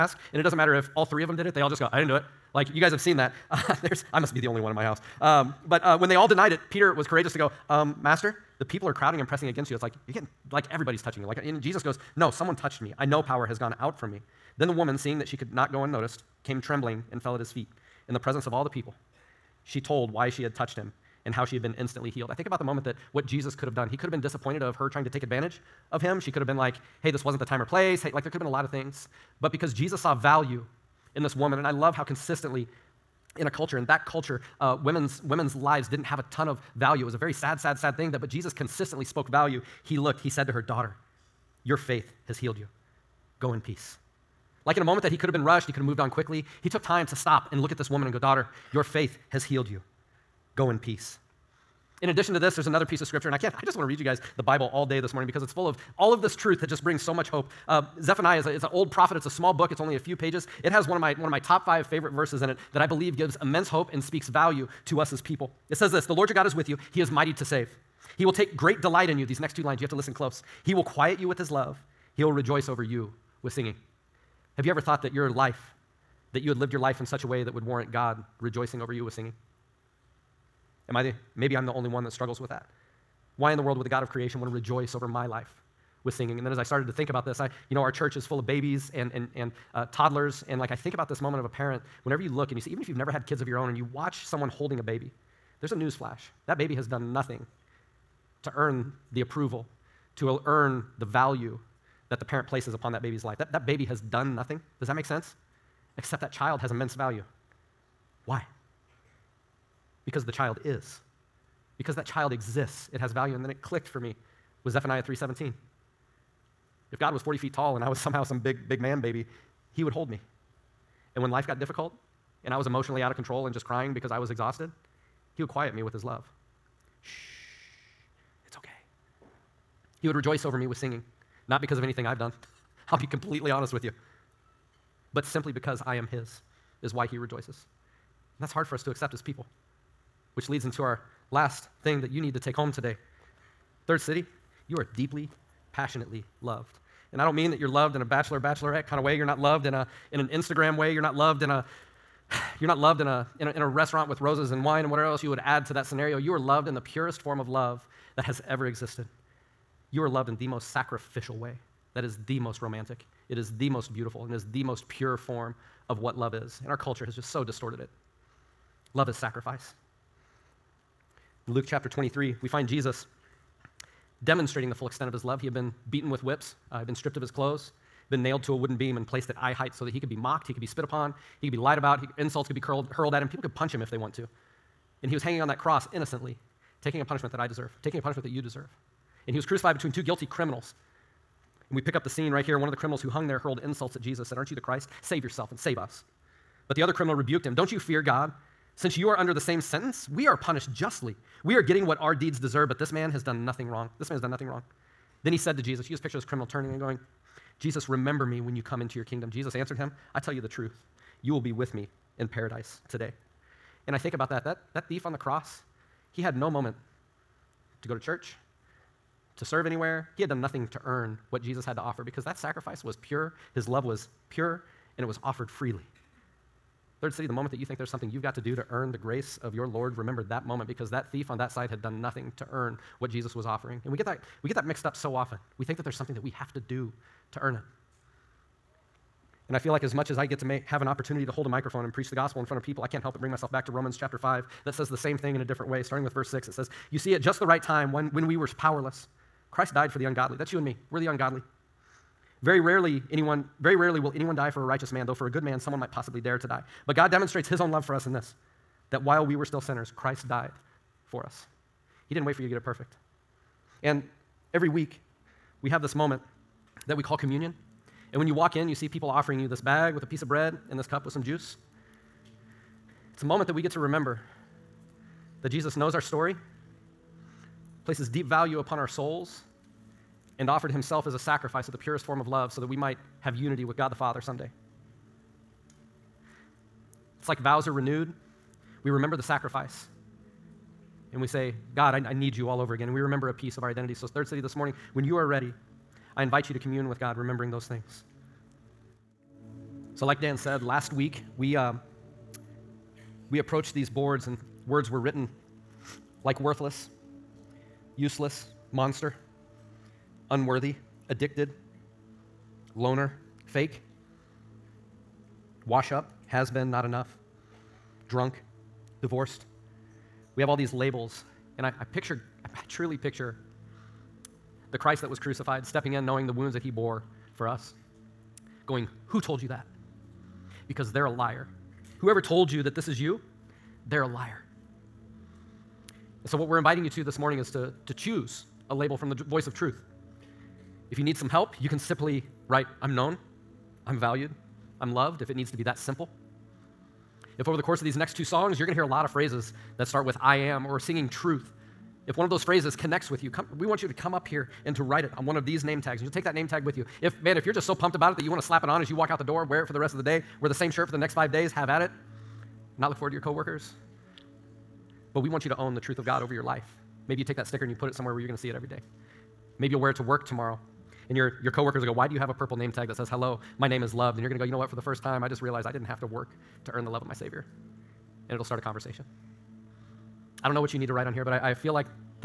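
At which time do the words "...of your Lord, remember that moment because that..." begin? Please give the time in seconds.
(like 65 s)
229 s.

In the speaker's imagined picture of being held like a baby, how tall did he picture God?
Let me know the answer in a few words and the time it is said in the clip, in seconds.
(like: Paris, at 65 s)
40 feet, at 117 s.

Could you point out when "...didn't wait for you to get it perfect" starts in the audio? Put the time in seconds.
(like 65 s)
262 s.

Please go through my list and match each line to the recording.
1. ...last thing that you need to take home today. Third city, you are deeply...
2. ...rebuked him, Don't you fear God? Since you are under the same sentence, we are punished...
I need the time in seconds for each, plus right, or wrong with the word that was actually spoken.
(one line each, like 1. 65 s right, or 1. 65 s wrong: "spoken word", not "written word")
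1. 141 s right
2. 197 s right.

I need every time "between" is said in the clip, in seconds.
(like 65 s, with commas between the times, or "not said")
189 s.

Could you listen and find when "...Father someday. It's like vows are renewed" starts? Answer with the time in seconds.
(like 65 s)
283 s.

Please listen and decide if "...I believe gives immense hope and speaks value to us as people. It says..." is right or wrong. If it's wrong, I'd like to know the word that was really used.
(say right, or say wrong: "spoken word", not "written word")
right.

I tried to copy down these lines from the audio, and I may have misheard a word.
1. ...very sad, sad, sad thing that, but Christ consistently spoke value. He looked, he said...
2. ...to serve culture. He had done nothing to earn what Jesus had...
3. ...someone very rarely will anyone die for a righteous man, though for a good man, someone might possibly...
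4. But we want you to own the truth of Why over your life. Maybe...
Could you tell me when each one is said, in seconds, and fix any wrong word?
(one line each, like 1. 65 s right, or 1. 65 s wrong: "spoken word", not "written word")
1. 37 s wrong: "Jesus", not "Christ"
2. 219 s wrong: "anywhere", not "culture"
3. 253 s wrong: "anyone", not "someone"
4. 365 s wrong: "God", not "Why".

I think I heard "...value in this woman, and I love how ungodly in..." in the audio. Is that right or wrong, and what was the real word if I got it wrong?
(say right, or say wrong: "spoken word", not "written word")
wrong: "consistently", not "ungodly".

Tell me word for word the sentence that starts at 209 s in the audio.
Jesus answered him, I tell you the truth.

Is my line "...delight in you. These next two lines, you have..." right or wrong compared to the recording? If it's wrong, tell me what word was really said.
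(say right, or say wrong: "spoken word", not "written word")
right.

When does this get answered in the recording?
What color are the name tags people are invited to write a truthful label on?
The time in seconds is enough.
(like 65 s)
372 s.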